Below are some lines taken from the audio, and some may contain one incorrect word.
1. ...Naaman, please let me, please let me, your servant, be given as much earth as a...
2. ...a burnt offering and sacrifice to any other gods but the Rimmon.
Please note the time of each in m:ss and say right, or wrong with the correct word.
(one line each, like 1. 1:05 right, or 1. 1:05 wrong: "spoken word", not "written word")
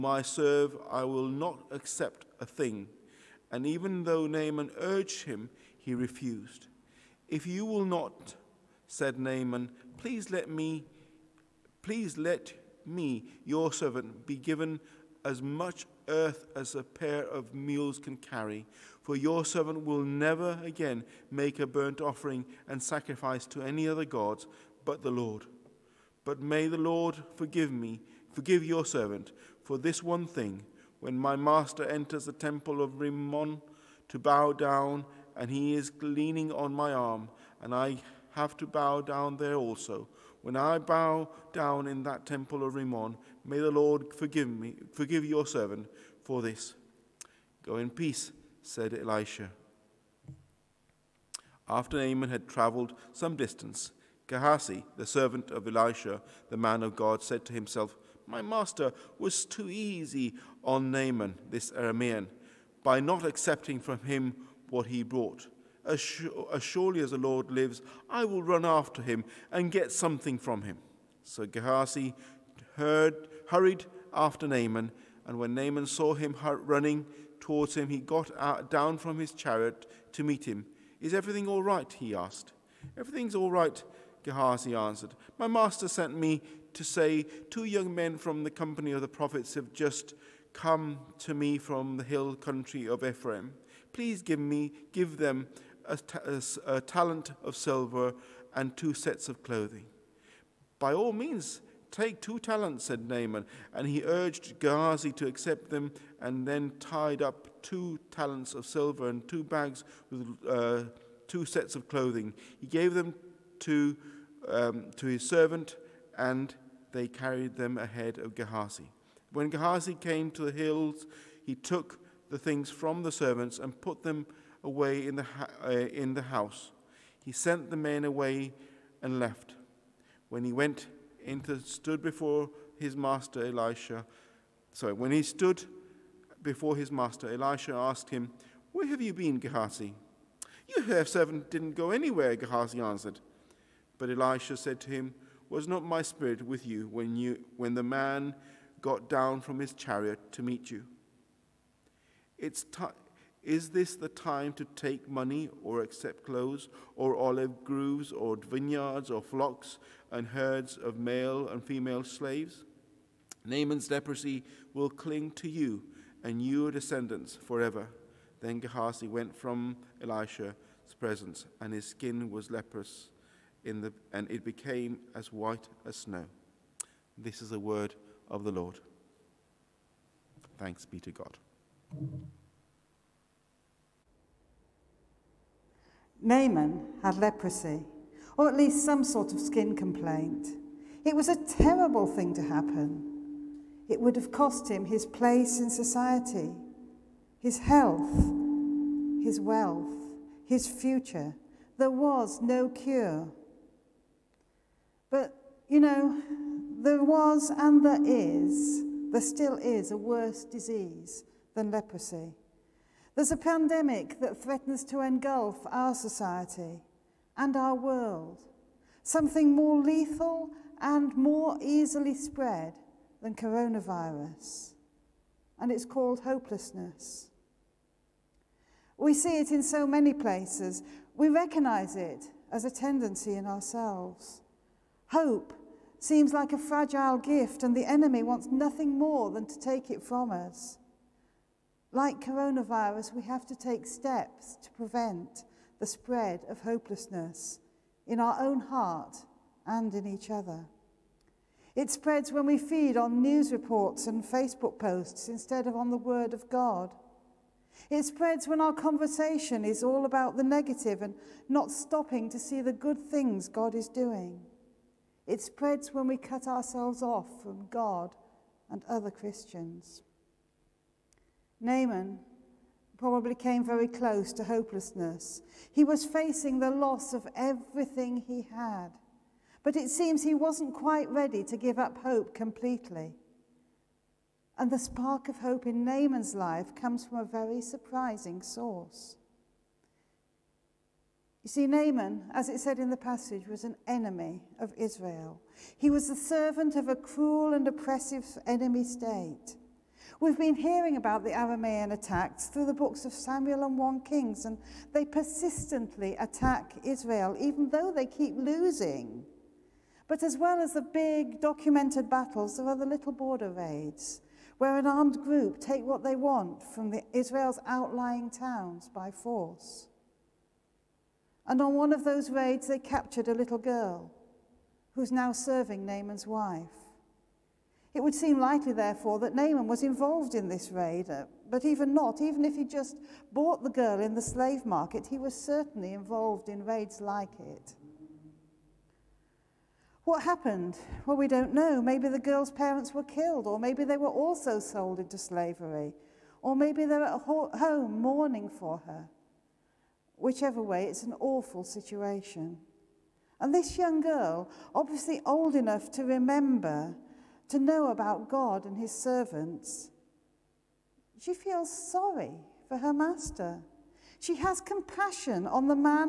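1. 0:09 right
2. 0:21 wrong: "Lord", not "Rimmon".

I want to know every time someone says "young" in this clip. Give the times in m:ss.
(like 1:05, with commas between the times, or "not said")
1:27, 5:53.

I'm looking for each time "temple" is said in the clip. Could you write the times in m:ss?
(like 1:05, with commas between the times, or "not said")
0:32, 0:42.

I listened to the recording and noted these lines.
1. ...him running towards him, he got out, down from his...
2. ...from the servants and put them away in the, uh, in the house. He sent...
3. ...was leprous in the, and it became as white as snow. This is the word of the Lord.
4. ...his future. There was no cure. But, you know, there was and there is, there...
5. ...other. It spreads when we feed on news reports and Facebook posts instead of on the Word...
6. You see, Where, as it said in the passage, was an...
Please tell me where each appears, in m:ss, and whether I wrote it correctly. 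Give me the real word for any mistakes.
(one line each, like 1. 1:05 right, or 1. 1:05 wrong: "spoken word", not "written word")
1. 1:16 right
2. 2:02 right
3. 2:52 right
4. 3:20 right
5. 4:10 right
6. 4:51 wrong: "Naaman", not "Where".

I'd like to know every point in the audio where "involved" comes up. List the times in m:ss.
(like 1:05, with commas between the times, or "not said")
5:29, 5:35.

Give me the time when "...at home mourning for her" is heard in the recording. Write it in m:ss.
5:47.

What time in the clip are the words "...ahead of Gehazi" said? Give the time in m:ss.
1:57.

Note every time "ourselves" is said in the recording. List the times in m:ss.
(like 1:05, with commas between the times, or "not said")
3:53, 4:26.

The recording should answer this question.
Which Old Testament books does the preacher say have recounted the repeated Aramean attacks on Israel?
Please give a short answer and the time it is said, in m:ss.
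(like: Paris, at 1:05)
Samuel and 1 Kings, at 5:03.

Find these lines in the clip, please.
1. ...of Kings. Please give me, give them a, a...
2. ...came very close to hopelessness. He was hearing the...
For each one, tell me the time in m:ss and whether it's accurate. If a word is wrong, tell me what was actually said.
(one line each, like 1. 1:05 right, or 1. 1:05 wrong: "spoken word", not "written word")
1. 1:32 wrong: "Ephraim", not "Kings"
2. 4:33 wrong: "facing", not "hearing".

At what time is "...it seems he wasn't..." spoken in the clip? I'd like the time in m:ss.
4:39.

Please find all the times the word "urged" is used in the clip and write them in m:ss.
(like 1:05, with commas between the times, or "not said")
0:04, 1:44.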